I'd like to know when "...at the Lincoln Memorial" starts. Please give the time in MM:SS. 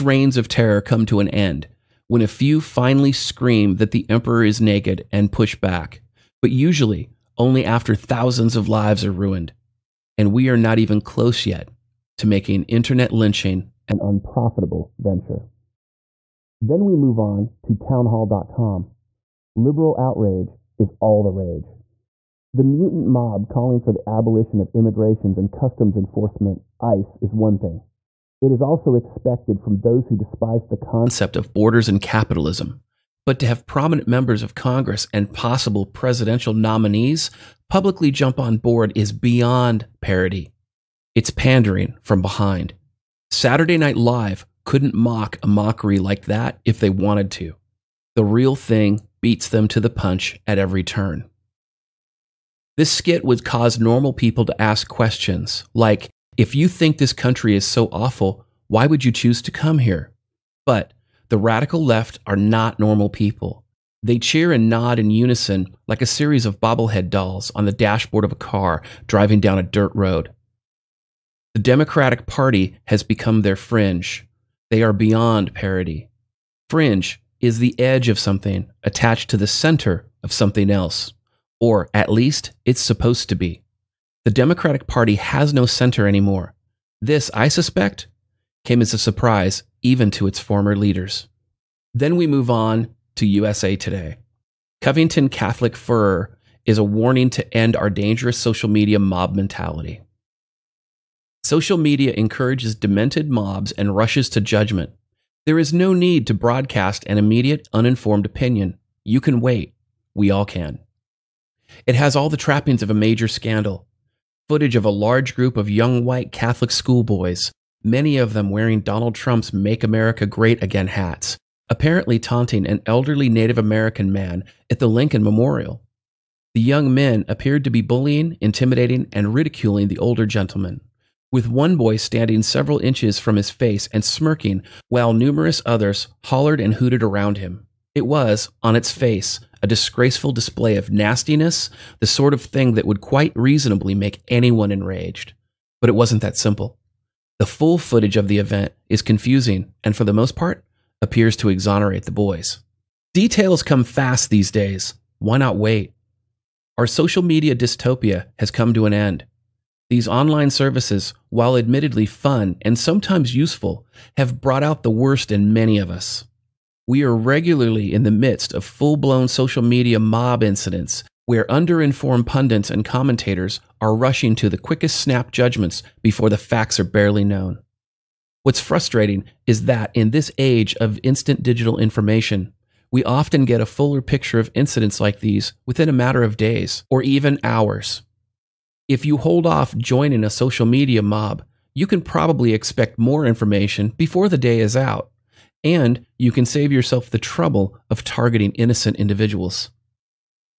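02:04.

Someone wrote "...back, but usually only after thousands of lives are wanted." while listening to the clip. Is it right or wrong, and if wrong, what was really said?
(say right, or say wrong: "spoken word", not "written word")
wrong: "ruined", not "wanted".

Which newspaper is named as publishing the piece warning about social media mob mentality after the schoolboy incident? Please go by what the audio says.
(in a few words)
USA Today.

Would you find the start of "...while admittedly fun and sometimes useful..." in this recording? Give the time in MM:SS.
02:41.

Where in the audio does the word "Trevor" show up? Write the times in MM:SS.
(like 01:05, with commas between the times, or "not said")
not said.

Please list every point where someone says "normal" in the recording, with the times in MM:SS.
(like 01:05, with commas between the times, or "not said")
00:53, 01:02.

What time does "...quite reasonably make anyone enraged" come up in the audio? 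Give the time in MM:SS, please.
02:23.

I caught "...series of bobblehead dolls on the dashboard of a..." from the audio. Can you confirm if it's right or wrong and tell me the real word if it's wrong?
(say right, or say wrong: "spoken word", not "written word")
right.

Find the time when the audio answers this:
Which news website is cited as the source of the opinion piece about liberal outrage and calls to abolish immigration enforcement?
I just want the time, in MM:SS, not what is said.
00:17.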